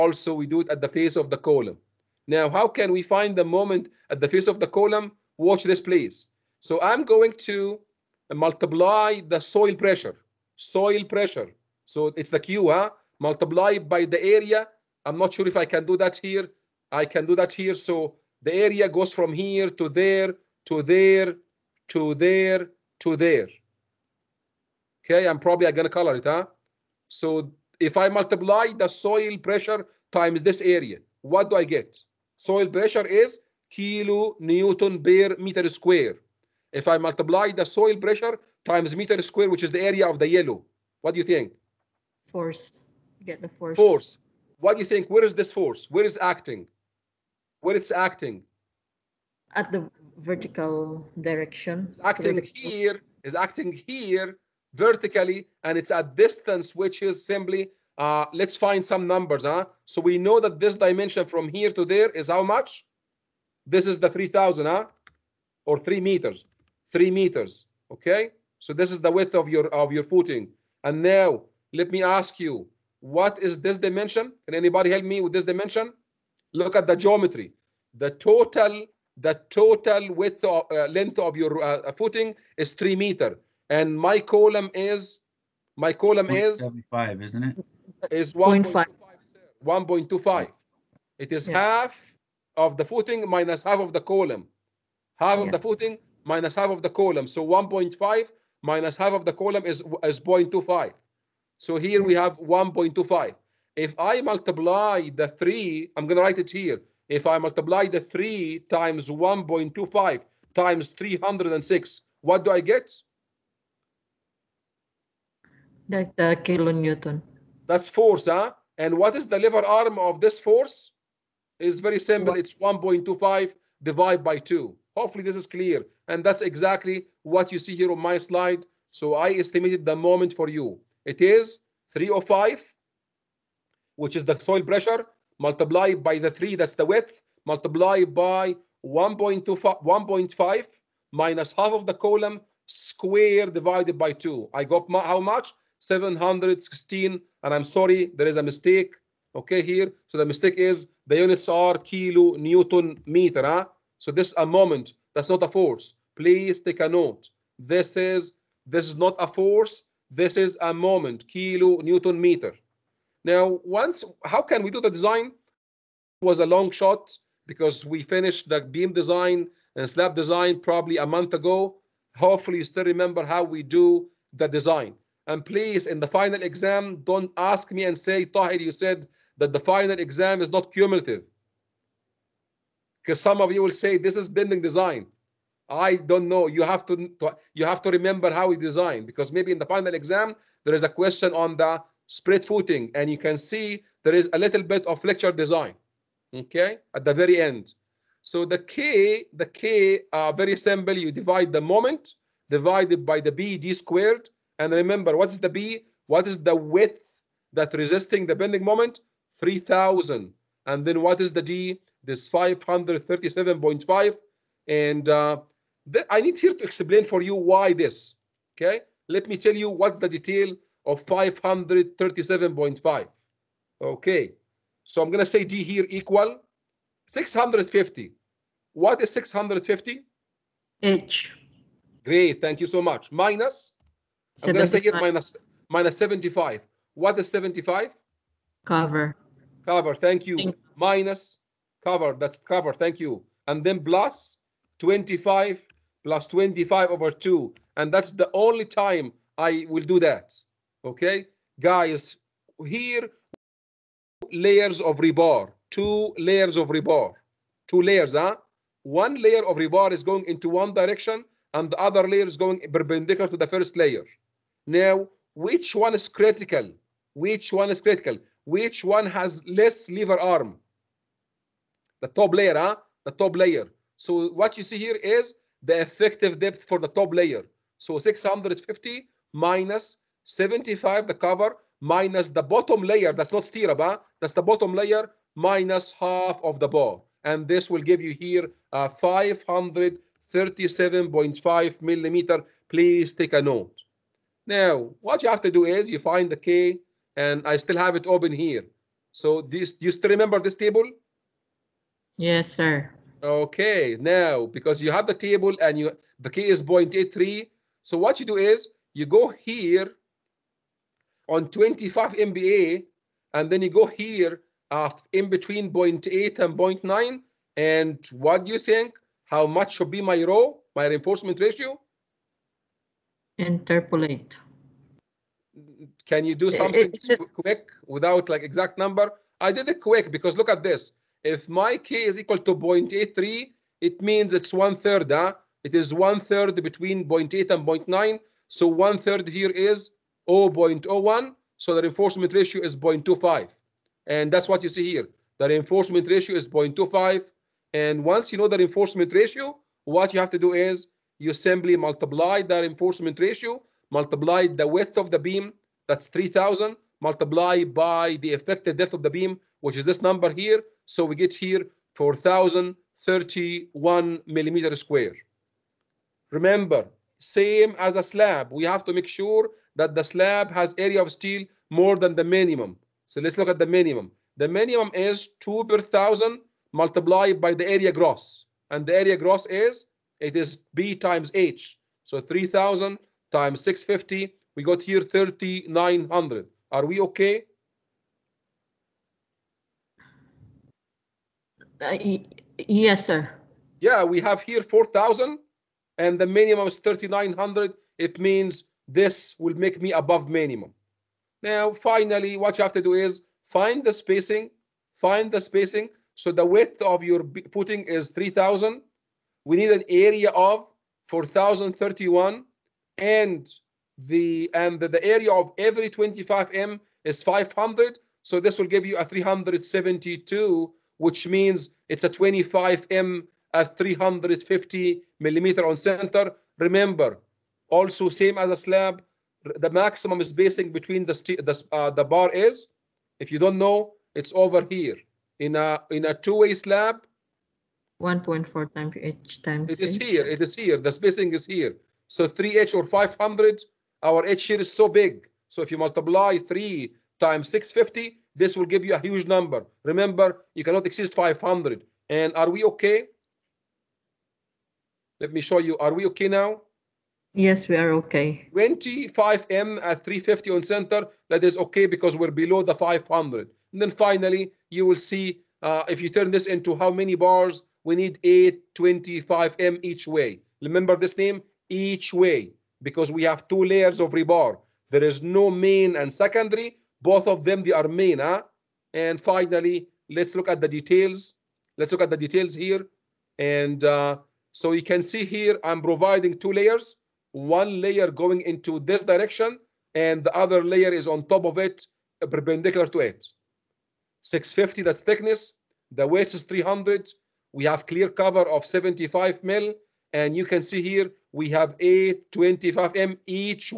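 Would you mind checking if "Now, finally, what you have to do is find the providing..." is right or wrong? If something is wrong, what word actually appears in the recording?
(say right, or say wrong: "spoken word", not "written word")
wrong: "spacing", not "providing".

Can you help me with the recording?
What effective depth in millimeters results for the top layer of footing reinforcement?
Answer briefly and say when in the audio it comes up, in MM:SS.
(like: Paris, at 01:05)
537.5 millimeter, at 04:48.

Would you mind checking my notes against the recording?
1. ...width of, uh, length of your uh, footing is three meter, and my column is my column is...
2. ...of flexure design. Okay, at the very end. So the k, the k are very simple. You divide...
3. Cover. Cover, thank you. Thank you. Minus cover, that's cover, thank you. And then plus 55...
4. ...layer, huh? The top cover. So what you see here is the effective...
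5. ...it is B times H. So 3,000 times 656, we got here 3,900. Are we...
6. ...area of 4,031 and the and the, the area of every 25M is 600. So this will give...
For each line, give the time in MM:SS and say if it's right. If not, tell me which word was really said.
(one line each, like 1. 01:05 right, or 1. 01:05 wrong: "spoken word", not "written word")
1. 01:20 right
2. 03:14 right
3. 03:58 wrong: "25", not "55"
4. 04:32 wrong: "layer", not "cover"
5. 06:20 wrong: "650", not "656"
6. 06:49 wrong: "500", not "600".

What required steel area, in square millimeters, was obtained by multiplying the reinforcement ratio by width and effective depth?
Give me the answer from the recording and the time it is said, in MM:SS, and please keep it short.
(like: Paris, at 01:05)
4,031 square millimeters, at 06:01.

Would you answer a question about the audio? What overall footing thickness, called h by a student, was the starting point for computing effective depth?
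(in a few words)
650.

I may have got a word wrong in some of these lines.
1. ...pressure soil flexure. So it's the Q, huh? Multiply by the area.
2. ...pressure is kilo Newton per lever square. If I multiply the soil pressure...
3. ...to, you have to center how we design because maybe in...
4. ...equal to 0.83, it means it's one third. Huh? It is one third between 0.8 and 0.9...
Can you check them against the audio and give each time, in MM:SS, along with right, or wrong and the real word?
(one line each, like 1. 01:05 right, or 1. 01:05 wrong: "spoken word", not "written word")
1. 00:09 wrong: "pressure", not "flexure"
2. 00:32 wrong: "meter", not "lever"
3. 03:06 wrong: "remember", not "center"
4. 05:32 right.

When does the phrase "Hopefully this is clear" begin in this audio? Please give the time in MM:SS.
02:04.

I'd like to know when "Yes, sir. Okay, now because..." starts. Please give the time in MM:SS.
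05:02.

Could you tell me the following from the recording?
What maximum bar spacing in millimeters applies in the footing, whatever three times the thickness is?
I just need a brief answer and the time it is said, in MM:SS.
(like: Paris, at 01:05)
500, at 07:22.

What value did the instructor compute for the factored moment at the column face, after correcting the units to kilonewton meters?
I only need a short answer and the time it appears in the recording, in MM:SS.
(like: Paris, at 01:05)
716, at 02:25.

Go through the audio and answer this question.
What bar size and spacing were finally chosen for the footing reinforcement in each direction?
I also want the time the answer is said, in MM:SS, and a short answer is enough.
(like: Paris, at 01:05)
25M at 350 mm, at 07:02.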